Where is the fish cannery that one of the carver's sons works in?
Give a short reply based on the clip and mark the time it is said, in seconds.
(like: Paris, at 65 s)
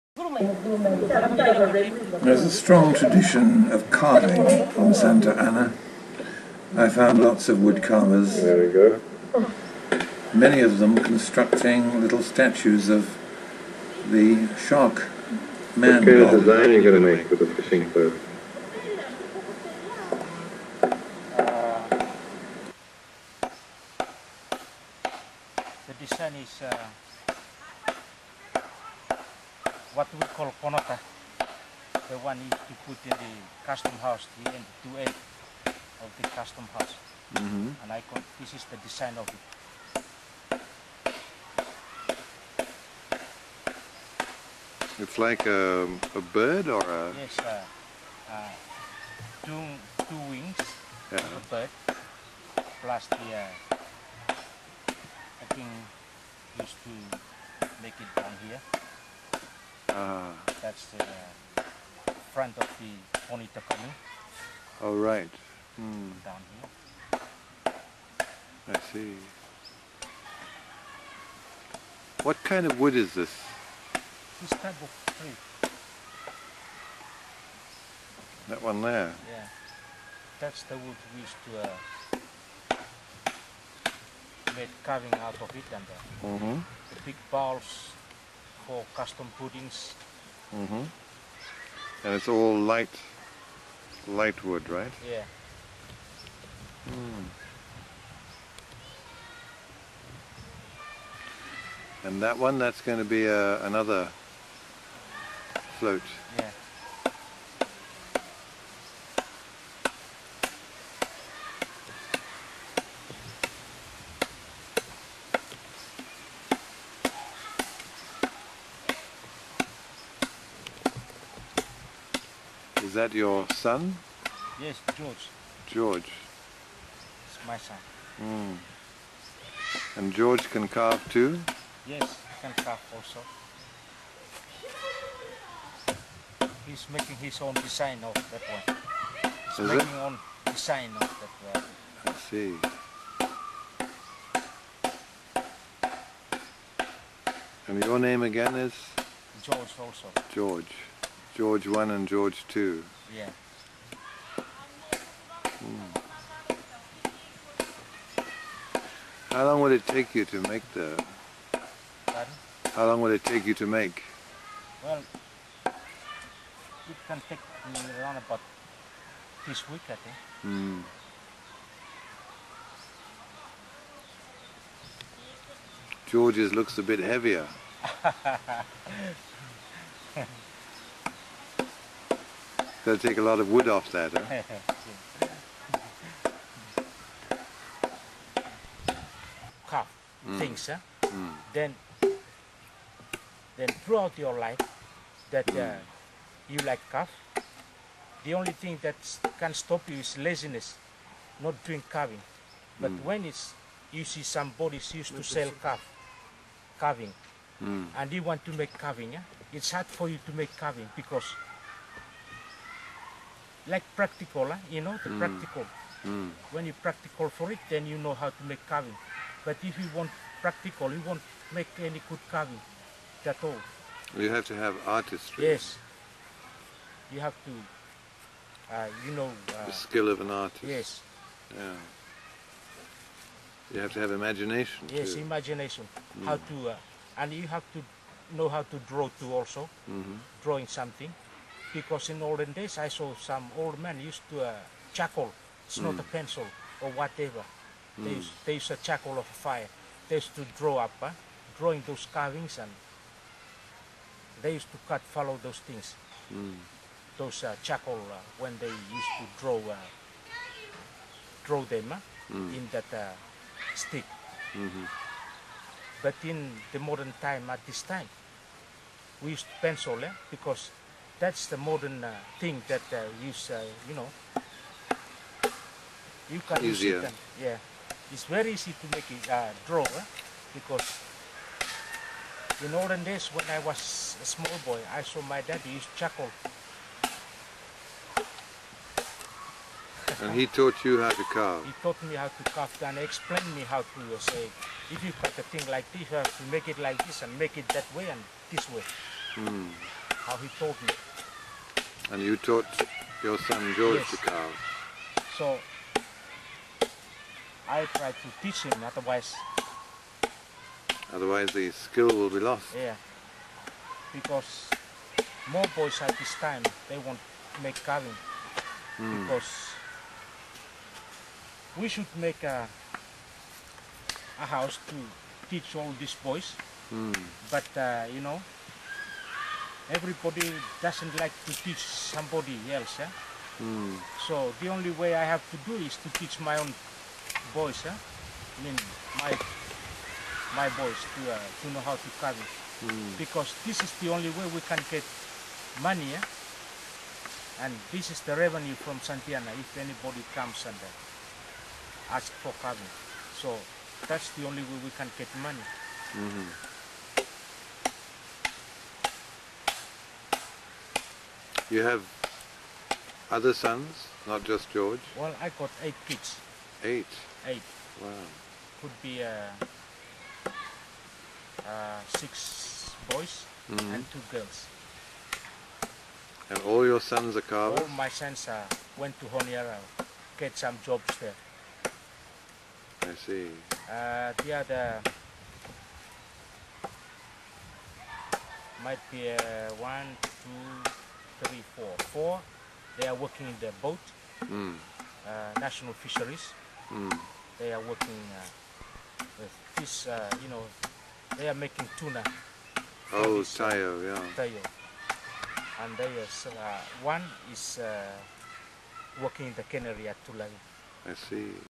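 Tulagi, at 410 s.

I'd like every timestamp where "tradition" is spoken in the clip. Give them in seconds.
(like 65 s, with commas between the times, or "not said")
2 s.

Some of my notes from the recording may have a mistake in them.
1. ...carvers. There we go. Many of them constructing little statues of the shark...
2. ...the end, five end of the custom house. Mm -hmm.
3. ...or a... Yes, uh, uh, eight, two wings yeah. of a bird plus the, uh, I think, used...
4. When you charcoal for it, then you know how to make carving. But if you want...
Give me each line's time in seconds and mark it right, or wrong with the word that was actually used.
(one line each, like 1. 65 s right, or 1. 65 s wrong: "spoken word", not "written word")
1. 7 s right
2. 34 s wrong: "two", not "five"
3. 46 s wrong: "two", not "eight"
4. 216 s wrong: "practical", not "charcoal".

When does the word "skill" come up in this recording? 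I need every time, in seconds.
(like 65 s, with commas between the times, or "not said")
229 s, 311 s.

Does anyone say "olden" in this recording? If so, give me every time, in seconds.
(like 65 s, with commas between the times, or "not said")
242 s, 282 s.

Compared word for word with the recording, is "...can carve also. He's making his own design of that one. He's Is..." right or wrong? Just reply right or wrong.
right.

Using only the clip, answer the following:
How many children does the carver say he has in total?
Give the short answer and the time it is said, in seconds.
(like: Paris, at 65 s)
8, at 365 s.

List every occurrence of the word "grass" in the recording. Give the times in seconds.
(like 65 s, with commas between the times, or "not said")
not said.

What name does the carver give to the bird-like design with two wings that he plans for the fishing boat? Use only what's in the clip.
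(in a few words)
Konota.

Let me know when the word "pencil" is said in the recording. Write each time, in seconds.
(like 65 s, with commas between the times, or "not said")
246 s, 269 s.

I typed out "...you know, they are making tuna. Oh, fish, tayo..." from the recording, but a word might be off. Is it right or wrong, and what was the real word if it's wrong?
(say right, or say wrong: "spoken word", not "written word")
right.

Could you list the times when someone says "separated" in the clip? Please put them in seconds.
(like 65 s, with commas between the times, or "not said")
not said.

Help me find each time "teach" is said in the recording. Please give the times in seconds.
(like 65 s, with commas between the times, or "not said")
308 s, 325 s, 331 s, 336 s.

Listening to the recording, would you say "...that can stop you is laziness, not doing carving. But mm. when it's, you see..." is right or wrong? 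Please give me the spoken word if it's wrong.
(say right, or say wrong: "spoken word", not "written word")
right.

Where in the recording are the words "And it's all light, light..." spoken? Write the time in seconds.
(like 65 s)
92 s.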